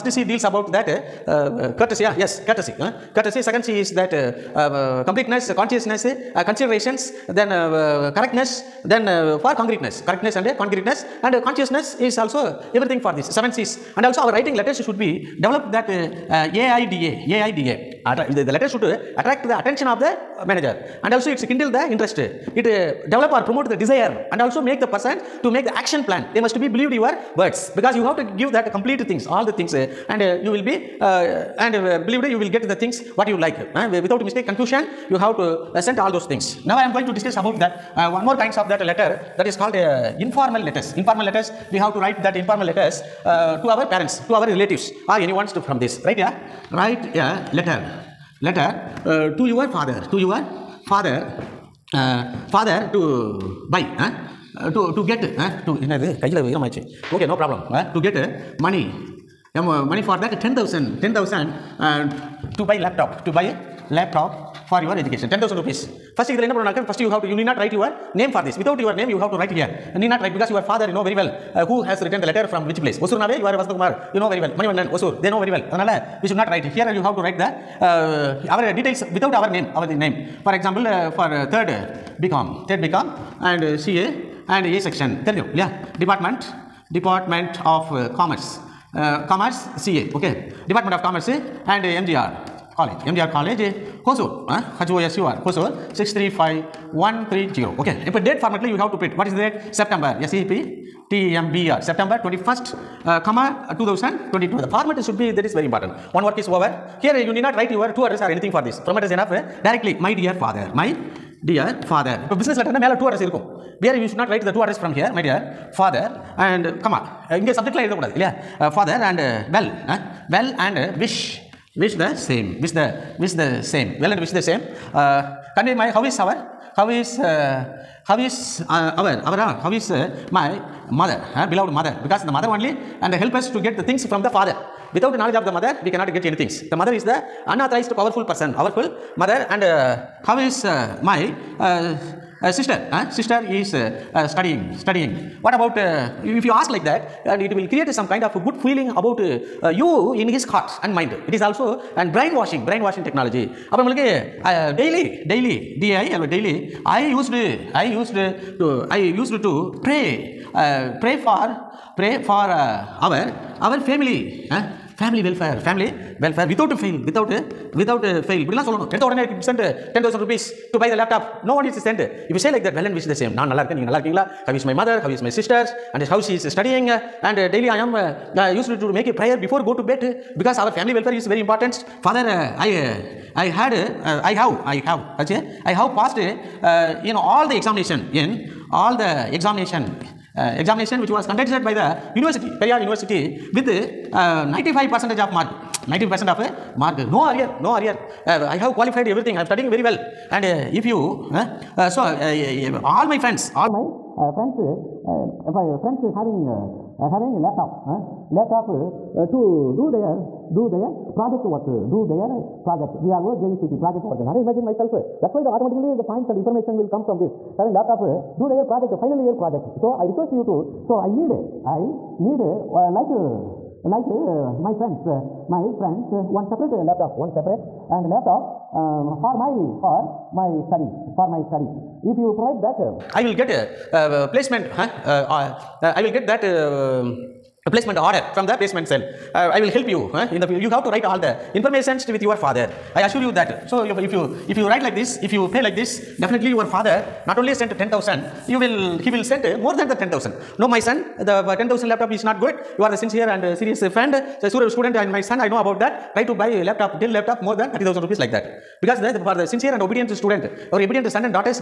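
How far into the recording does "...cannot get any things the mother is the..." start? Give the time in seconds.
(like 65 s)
135 s.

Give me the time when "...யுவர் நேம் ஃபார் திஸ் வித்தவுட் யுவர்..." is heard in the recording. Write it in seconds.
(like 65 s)
67 s.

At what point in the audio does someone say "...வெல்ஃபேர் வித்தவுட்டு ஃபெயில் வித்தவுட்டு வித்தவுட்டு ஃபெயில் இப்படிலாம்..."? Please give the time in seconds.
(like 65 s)
166 s.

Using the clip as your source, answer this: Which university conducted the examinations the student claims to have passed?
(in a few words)
Periyar University.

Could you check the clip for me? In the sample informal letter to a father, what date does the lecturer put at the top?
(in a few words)
September 21, 2022.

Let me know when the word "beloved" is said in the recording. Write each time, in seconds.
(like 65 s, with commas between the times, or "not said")
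131 s.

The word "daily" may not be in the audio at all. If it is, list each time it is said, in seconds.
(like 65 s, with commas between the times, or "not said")
154 s, 177 s.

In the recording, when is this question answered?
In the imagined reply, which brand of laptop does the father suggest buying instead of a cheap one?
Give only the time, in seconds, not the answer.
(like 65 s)
257 s.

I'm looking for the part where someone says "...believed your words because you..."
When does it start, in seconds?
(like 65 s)
26 s.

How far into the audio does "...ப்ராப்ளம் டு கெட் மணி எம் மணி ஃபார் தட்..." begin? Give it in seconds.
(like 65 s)
57 s.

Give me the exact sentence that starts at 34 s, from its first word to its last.
Without mistake, confusion, you have to uh, send all those things.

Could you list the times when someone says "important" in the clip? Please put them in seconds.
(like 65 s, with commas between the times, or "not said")
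105 s, 181 s.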